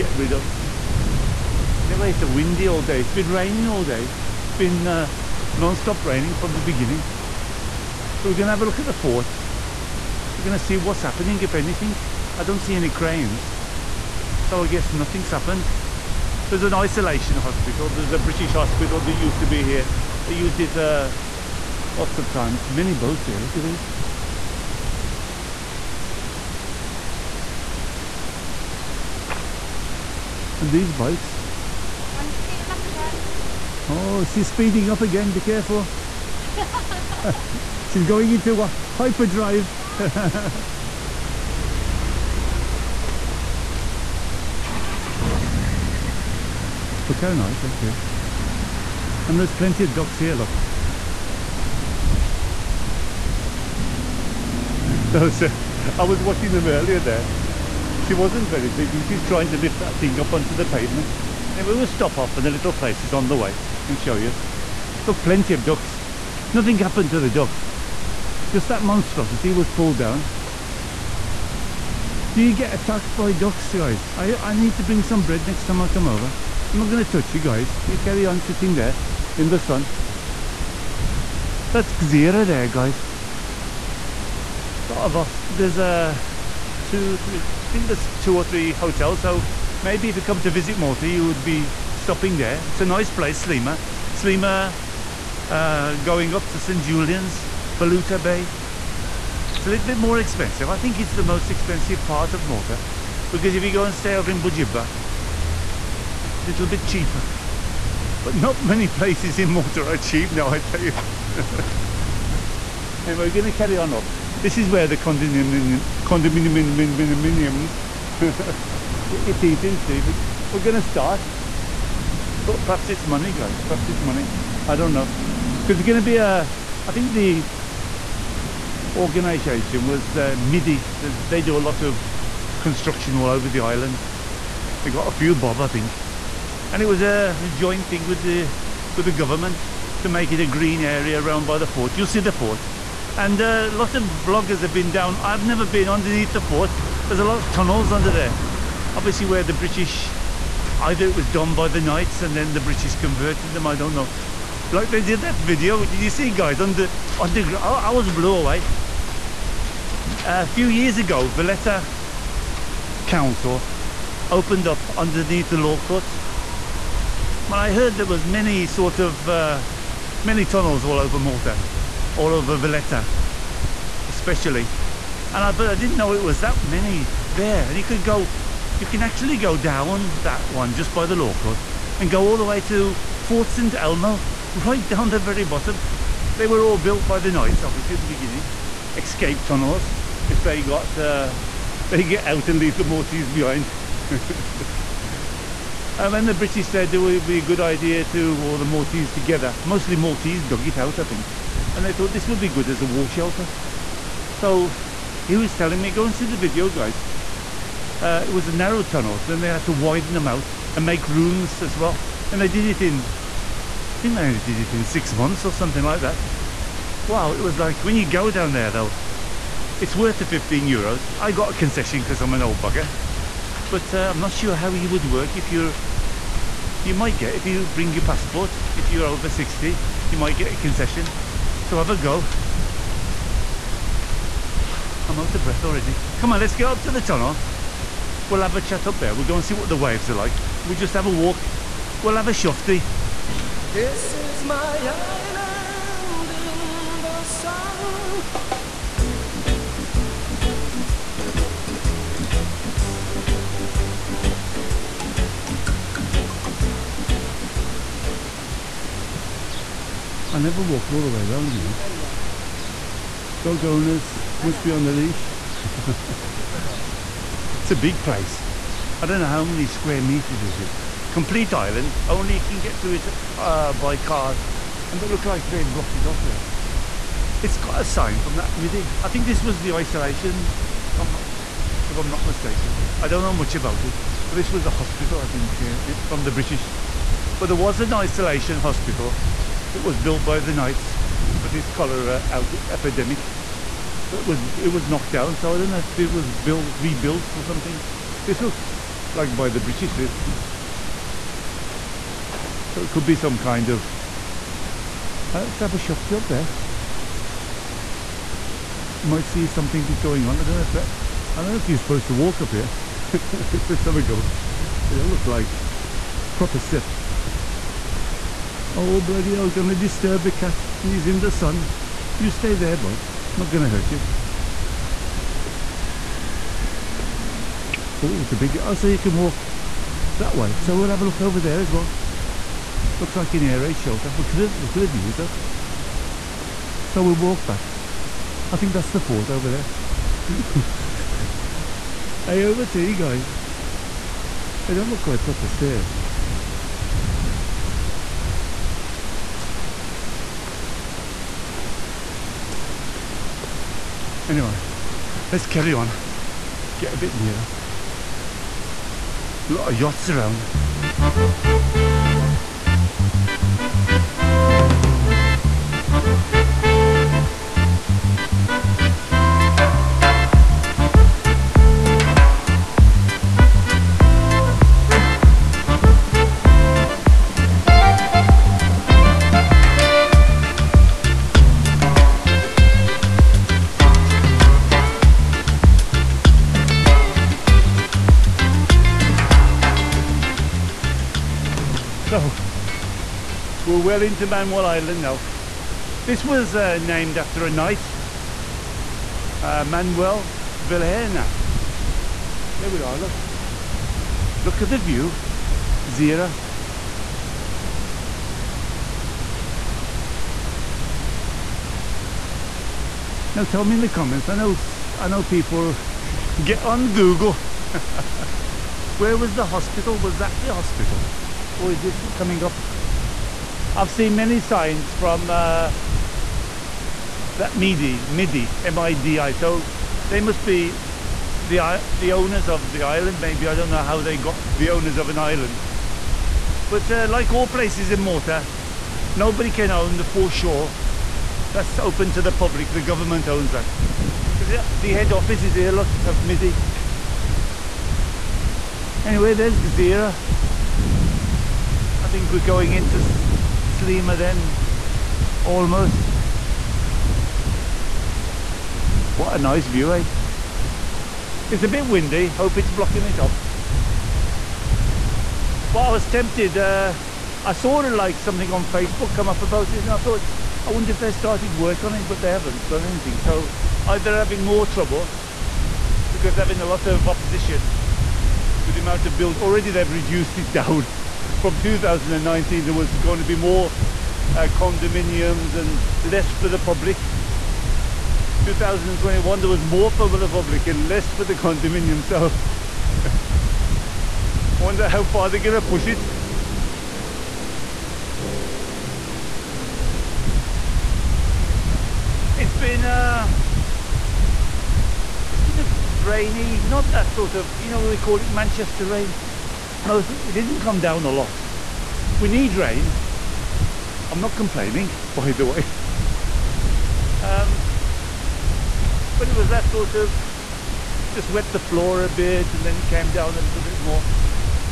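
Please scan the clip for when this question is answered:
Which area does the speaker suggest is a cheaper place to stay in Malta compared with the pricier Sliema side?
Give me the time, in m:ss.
1:44.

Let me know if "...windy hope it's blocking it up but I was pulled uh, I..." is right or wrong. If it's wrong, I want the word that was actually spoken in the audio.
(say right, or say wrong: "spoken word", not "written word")
wrong: "tempted", not "pulled".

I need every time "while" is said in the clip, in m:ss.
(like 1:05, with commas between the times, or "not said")
not said.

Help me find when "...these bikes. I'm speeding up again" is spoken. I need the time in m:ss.
0:30.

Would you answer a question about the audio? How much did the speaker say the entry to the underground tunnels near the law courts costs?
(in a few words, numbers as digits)
15 euros.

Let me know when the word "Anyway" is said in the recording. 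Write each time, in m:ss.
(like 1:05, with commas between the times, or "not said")
0:01, 5:54, 7:29.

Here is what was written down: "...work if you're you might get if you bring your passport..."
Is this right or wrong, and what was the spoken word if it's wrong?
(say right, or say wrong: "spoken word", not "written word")
right.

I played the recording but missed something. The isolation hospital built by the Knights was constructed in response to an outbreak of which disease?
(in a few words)
cholera.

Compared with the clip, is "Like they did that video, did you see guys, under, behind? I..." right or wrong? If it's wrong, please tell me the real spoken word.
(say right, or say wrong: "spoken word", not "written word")
wrong: "underground", not "behind".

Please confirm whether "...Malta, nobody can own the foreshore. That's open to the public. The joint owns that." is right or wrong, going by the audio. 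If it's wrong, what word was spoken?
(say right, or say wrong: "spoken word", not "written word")
wrong: "government", not "joint".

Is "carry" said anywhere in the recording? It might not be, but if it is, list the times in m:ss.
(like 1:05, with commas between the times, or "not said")
1:17, 1:53, 5:55.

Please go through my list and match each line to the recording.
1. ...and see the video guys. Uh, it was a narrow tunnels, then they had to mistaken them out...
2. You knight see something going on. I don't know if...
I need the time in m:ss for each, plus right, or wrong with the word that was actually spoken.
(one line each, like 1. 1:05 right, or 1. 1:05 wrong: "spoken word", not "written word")
1. 3:26 wrong: "widen", not "mistaken"
2. 5:09 wrong: "might", not "knight".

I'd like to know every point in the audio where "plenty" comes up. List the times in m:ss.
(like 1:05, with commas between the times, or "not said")
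0:49, 1:05.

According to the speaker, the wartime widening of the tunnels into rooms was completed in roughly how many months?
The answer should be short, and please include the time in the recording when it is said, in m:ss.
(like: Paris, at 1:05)
6, at 3:34.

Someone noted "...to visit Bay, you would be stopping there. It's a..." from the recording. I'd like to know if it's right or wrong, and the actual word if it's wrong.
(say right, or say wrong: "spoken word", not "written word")
wrong: "Malta", not "Bay".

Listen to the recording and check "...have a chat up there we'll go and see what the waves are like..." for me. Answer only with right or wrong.
right.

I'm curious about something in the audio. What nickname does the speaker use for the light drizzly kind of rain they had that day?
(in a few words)
Manchester rain.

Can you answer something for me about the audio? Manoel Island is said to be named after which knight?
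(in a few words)
Manoel Vilhena.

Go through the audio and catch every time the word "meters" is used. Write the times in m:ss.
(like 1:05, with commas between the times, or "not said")
4:30.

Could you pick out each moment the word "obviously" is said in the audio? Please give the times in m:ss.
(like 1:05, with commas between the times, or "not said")
2:28, 3:07.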